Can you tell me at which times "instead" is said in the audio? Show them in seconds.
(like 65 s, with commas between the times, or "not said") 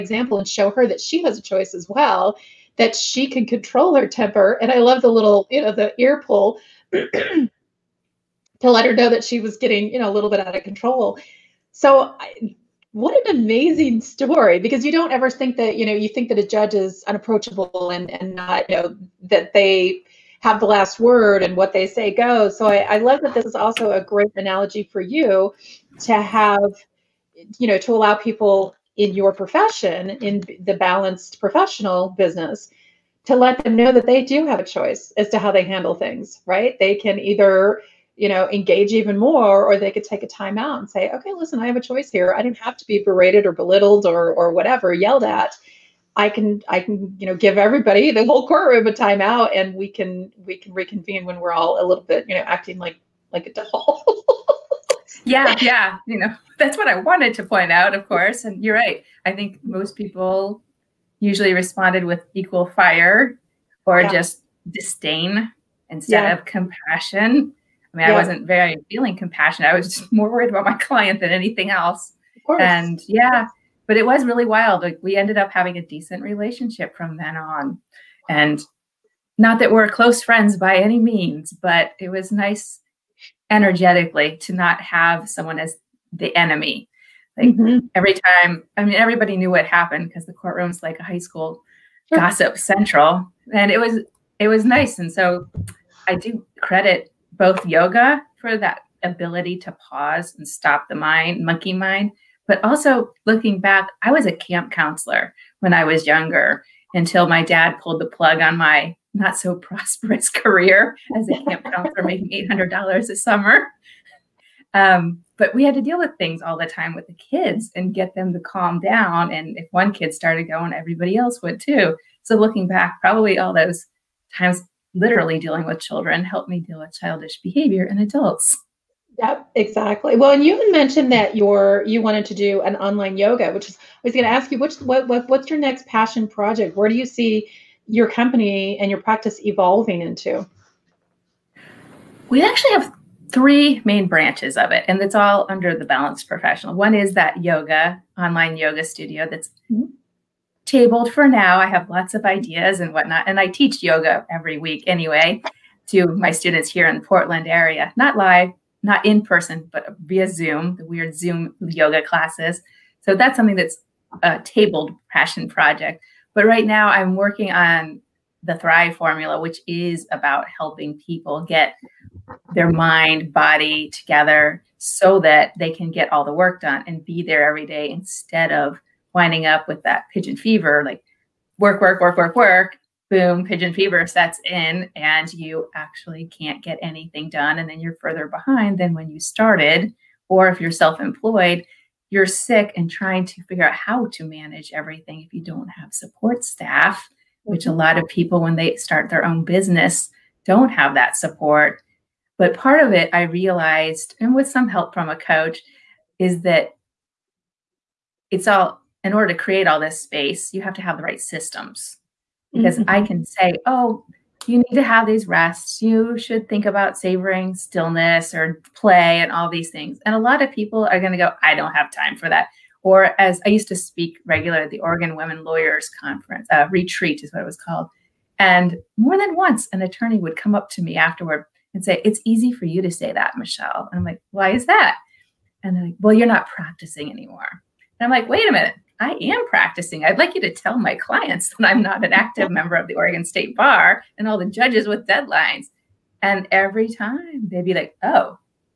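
65 s, 177 s.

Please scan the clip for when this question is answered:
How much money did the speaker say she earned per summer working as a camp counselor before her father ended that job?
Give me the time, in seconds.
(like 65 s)
112 s.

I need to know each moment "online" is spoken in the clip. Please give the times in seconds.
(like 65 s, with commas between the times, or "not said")
132 s, 148 s.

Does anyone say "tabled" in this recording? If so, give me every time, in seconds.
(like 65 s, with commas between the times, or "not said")
150 s, 164 s.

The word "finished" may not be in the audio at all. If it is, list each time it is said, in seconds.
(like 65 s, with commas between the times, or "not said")
not said.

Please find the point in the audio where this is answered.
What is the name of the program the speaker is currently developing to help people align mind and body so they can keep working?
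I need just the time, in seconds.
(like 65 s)
168 s.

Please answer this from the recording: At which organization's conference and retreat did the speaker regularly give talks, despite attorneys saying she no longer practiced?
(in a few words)
Oregon Women Lawyers.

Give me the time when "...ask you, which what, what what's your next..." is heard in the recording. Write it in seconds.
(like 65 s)
134 s.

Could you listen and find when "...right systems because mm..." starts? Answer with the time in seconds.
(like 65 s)
211 s.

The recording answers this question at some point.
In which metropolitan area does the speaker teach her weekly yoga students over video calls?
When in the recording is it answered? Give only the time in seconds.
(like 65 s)
157 s.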